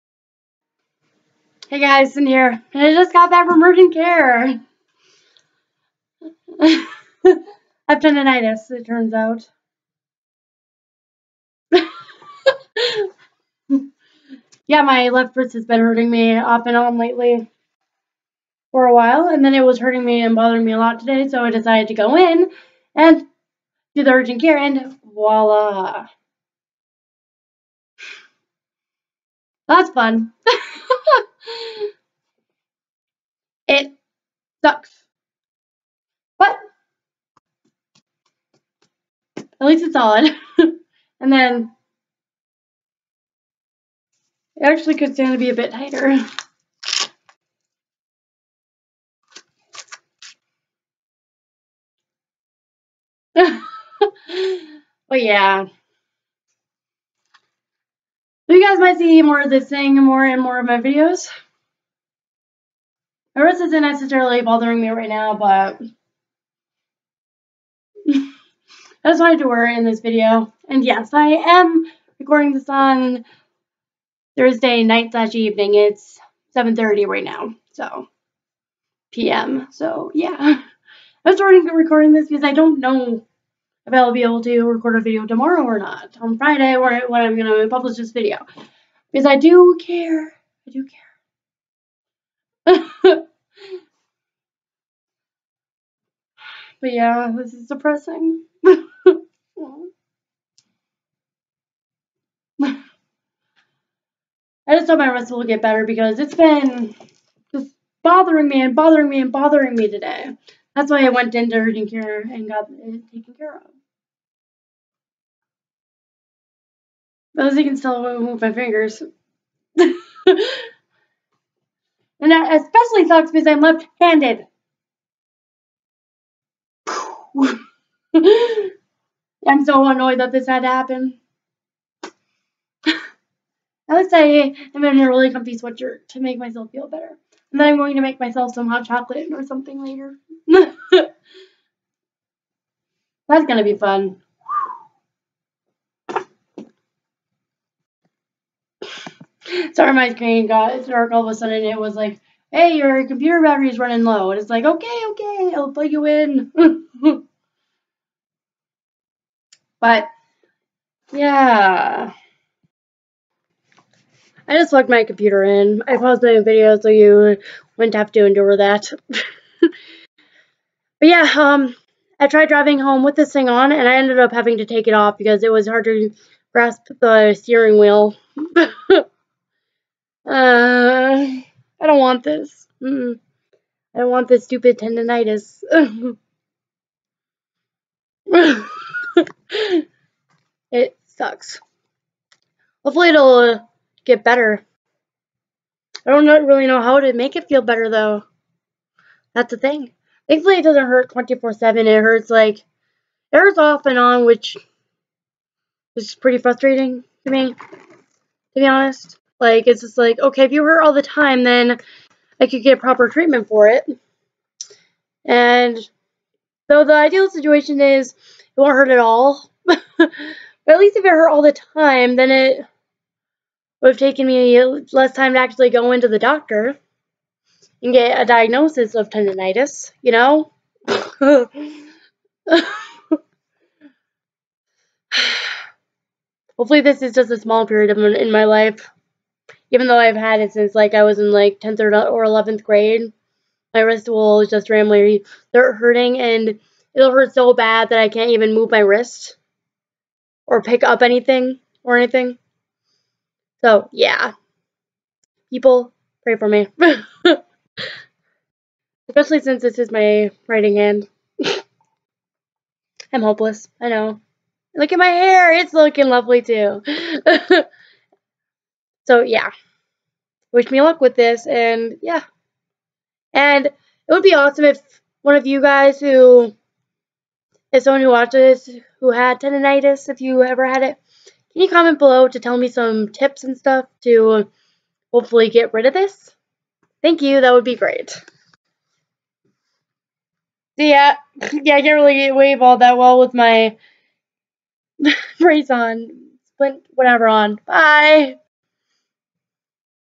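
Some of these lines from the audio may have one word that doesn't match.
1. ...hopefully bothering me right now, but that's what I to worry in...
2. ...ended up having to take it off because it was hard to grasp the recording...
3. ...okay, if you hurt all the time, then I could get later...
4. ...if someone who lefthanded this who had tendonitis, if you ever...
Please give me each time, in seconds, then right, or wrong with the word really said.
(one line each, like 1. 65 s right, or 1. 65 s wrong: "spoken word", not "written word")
1. 63 s wrong: "necessarily", not "hopefully"
2. 173 s wrong: "steering", not "recording"
3. 210 s wrong: "proper", not "later"
4. 277 s wrong: "watched", not "lefthanded".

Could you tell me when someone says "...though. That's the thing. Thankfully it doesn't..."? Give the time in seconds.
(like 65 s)
197 s.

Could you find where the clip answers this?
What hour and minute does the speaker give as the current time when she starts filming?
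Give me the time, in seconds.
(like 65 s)
76 s.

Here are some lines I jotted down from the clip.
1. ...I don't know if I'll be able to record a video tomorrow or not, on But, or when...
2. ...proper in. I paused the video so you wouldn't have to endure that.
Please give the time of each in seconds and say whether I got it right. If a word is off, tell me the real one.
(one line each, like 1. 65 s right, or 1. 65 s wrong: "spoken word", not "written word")
1. 82 s wrong: "Friday", not "But"
2. 165 s wrong: "computer", not "proper".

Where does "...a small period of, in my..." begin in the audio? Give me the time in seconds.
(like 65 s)
237 s.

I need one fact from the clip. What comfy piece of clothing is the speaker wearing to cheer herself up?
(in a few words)
Sweatshirt.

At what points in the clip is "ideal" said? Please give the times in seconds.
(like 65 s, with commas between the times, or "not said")
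216 s.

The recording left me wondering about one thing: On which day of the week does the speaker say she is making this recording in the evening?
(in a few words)
Thursday.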